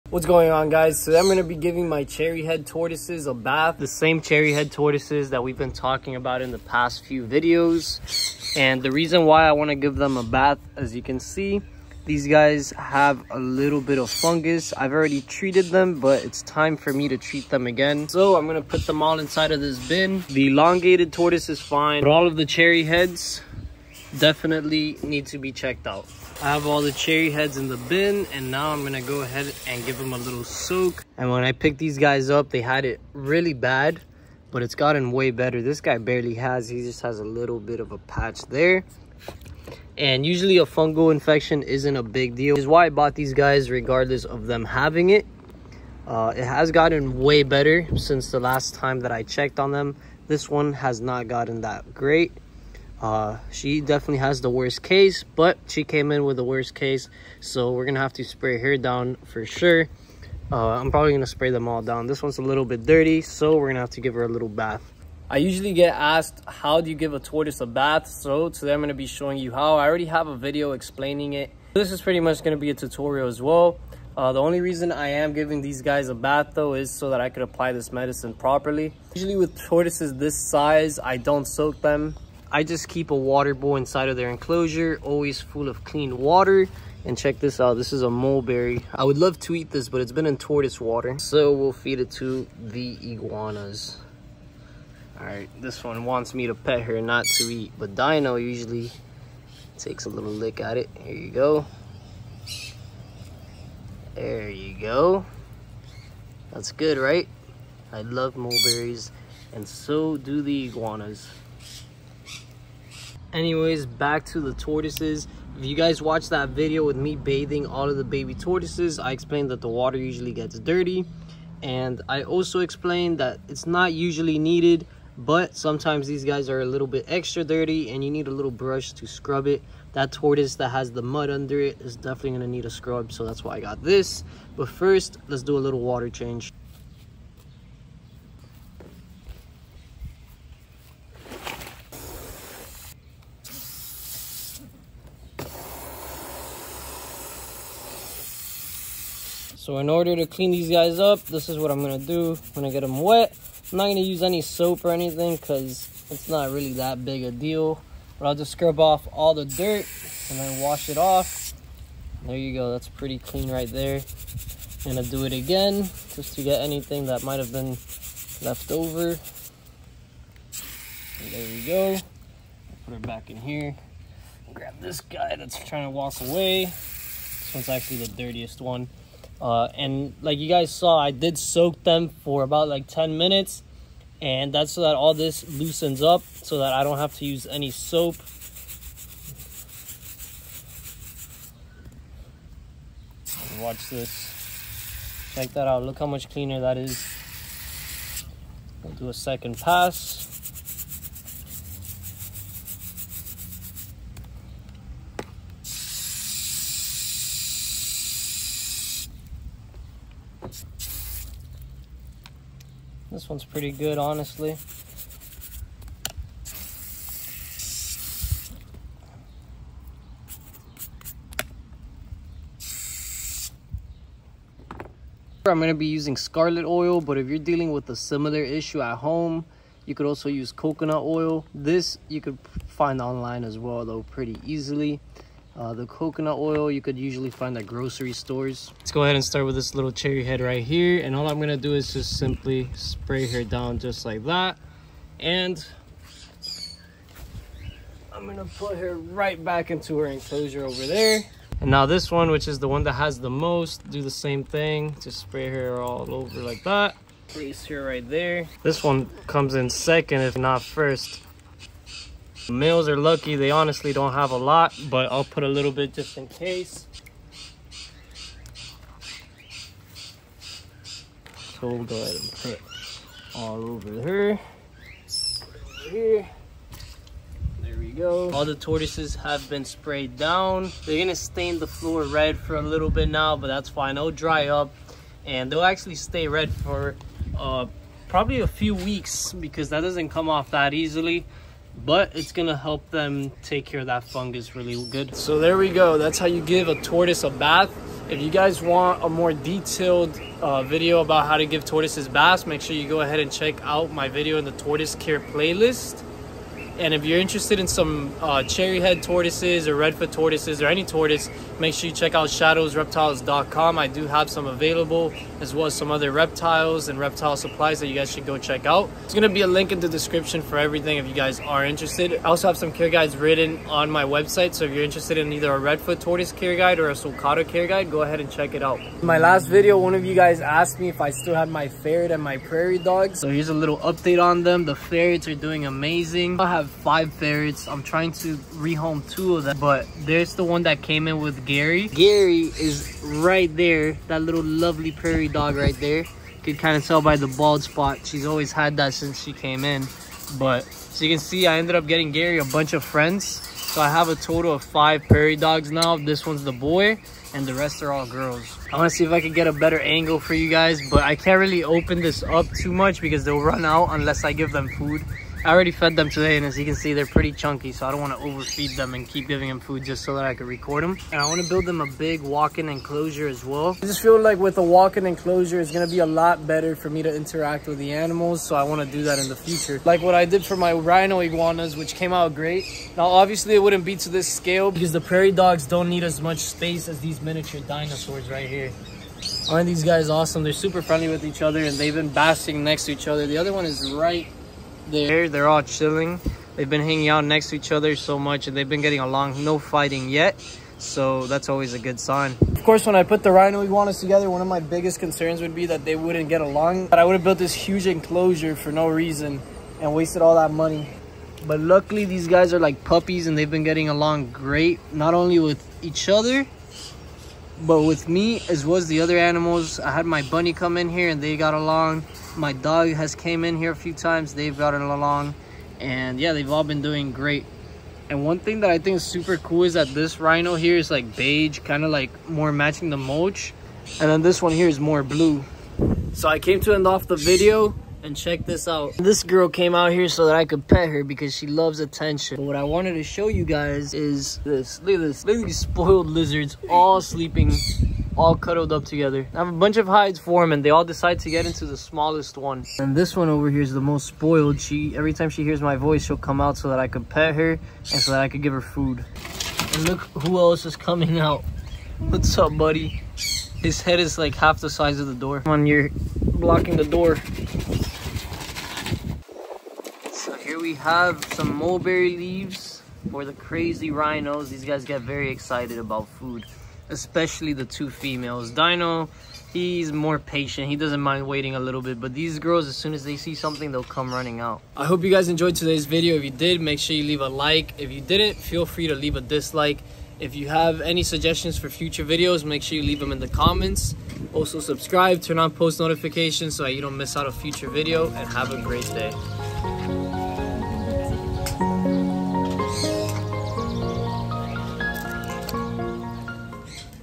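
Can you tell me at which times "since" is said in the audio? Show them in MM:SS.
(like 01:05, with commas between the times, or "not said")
00:47, 05:48.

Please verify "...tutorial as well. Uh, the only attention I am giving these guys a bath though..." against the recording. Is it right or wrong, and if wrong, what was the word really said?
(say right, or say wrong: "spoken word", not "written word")
wrong: "reason", not "attention".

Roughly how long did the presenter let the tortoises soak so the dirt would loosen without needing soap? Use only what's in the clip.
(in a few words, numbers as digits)
10 minutes.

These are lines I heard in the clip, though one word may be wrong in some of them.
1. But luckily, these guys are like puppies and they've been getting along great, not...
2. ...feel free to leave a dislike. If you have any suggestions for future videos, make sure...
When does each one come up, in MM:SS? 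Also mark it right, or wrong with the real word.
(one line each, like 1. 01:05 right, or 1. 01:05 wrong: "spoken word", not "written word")
1. 06:51 right
2. 08:08 right.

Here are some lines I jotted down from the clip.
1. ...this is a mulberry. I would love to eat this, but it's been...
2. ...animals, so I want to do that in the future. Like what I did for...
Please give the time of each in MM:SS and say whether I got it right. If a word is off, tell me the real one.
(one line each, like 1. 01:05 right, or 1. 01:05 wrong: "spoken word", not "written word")
1. 01:27 right
2. 06:17 right.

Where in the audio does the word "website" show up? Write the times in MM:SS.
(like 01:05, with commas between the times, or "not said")
05:24.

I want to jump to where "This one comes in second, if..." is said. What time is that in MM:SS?
04:18.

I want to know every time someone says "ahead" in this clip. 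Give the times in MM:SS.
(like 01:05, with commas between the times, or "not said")
00:29, 03:59, 04:31, 05:03, 05:28.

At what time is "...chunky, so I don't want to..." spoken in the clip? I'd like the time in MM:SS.
06:07.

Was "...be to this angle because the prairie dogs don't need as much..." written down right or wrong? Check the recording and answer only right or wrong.
wrong.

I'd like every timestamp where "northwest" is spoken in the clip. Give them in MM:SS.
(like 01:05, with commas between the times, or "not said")
not said.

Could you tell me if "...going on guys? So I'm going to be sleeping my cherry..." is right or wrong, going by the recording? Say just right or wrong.
wrong.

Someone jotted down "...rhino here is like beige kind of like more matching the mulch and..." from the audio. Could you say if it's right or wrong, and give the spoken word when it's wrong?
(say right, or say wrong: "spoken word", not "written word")
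right.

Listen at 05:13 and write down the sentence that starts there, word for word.
I do have some available, as well as some other reptiles and reptile supplies that you guys should go check out.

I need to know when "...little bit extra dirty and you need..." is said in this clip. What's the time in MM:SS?
02:06.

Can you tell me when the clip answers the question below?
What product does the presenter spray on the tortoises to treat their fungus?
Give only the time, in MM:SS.
03:46.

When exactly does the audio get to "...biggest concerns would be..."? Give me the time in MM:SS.
06:44.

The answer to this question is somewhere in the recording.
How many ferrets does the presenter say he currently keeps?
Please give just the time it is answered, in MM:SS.
05:36.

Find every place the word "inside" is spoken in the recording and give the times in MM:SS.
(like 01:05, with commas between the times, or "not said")
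00:19, 01:23.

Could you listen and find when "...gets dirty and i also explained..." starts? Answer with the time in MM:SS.
02:00.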